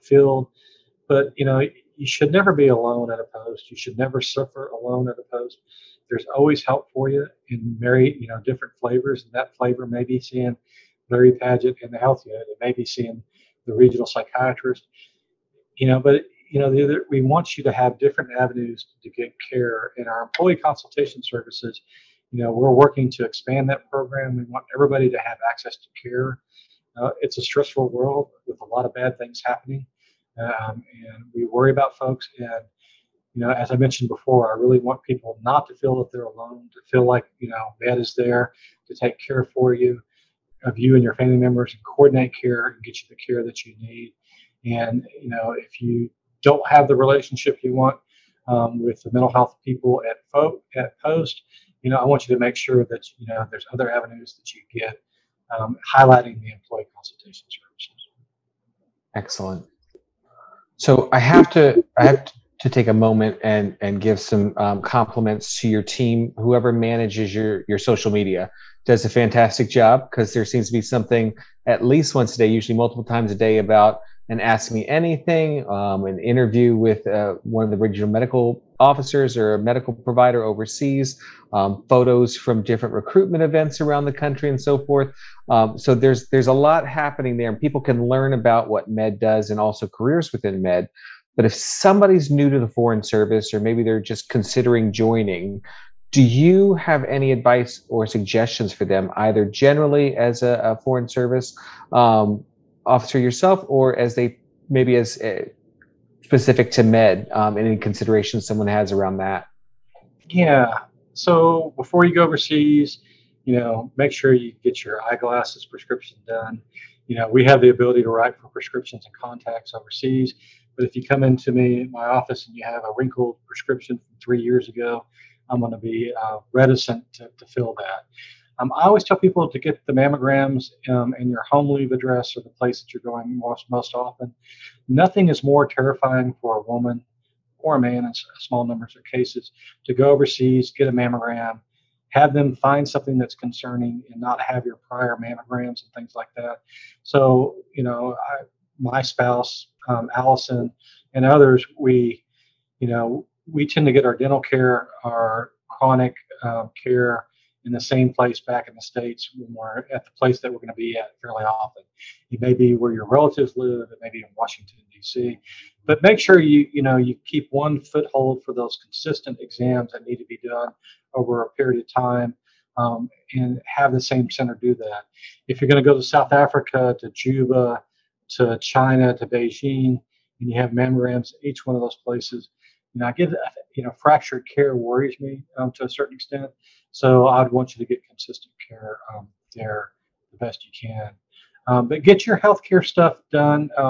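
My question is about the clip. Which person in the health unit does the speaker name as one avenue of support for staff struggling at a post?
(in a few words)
Larry Padget.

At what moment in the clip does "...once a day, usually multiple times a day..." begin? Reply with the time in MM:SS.
01:12.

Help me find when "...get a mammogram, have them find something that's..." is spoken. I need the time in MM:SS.
02:20.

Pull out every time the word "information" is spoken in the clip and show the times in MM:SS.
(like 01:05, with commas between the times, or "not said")
not said.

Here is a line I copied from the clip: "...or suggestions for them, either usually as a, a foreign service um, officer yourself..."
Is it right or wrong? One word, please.
wrong.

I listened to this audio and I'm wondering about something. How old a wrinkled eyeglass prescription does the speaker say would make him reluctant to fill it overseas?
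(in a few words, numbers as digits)
3 years.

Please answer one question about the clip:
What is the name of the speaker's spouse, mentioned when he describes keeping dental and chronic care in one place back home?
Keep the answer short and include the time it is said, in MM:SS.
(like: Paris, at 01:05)
Allison, at 02:30.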